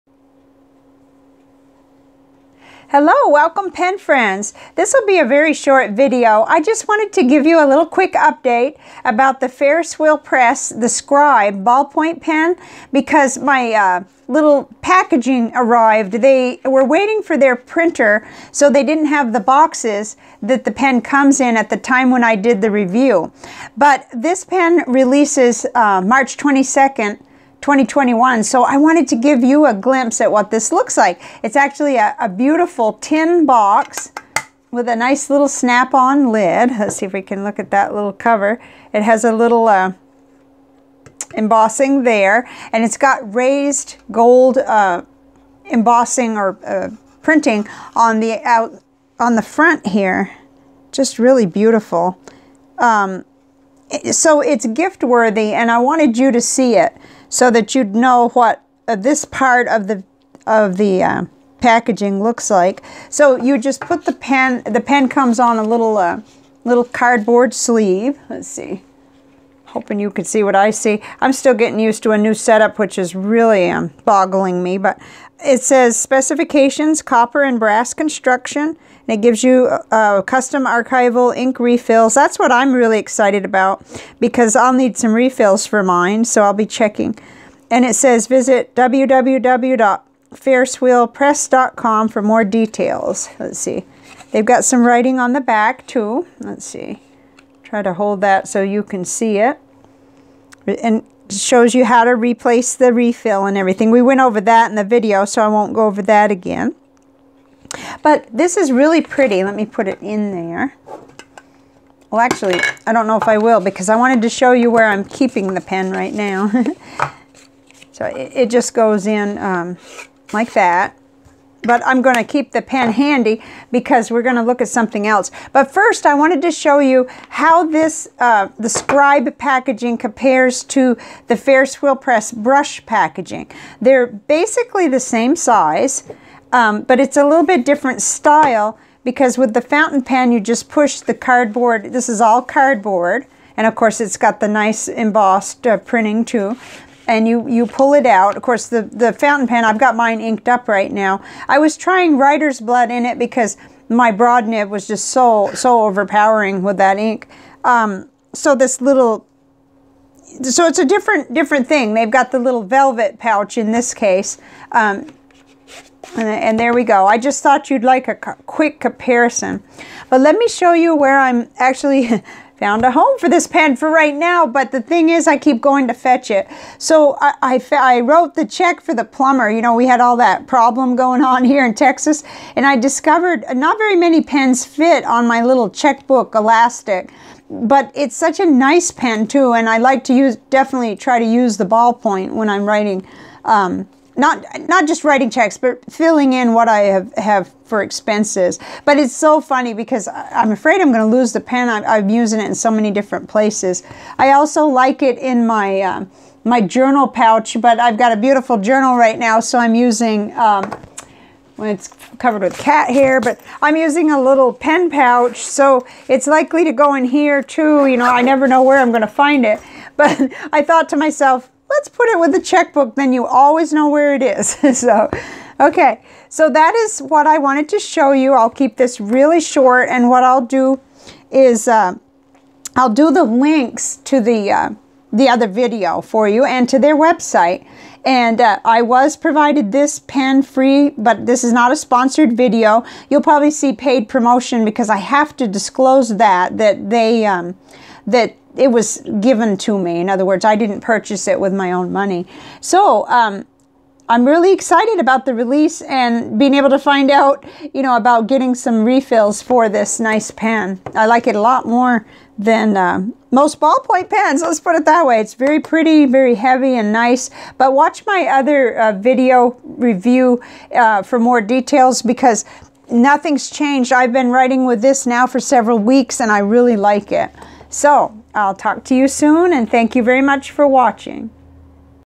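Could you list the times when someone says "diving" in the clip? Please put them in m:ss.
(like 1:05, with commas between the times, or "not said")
not said.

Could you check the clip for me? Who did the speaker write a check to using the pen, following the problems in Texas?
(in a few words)
The plumber.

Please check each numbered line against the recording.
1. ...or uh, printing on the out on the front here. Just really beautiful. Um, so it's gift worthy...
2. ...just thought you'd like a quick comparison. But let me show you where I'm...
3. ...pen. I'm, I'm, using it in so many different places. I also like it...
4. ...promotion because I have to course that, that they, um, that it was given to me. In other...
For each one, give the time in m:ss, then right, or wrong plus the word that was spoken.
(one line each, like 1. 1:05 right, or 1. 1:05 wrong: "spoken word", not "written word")
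1. 0:46 right
2. 2:47 right
3. 3:21 right
4. 4:04 wrong: "disclose", not "course".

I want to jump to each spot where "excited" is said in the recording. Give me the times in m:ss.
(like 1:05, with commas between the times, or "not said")
1:22, 4:14.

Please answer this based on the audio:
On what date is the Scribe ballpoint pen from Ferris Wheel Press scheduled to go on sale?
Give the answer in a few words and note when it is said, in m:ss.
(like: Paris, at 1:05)
March 22nd 2021, at 0:26.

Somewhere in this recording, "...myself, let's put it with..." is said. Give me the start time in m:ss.
3:40.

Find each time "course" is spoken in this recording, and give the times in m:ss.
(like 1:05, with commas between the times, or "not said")
2:23, 2:28.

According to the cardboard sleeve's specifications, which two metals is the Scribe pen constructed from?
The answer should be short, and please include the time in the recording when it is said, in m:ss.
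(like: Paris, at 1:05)
Copper and brass, at 1:17.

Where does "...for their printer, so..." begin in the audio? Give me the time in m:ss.
0:17.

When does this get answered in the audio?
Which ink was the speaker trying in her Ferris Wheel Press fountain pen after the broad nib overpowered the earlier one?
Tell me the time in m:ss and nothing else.
2:32.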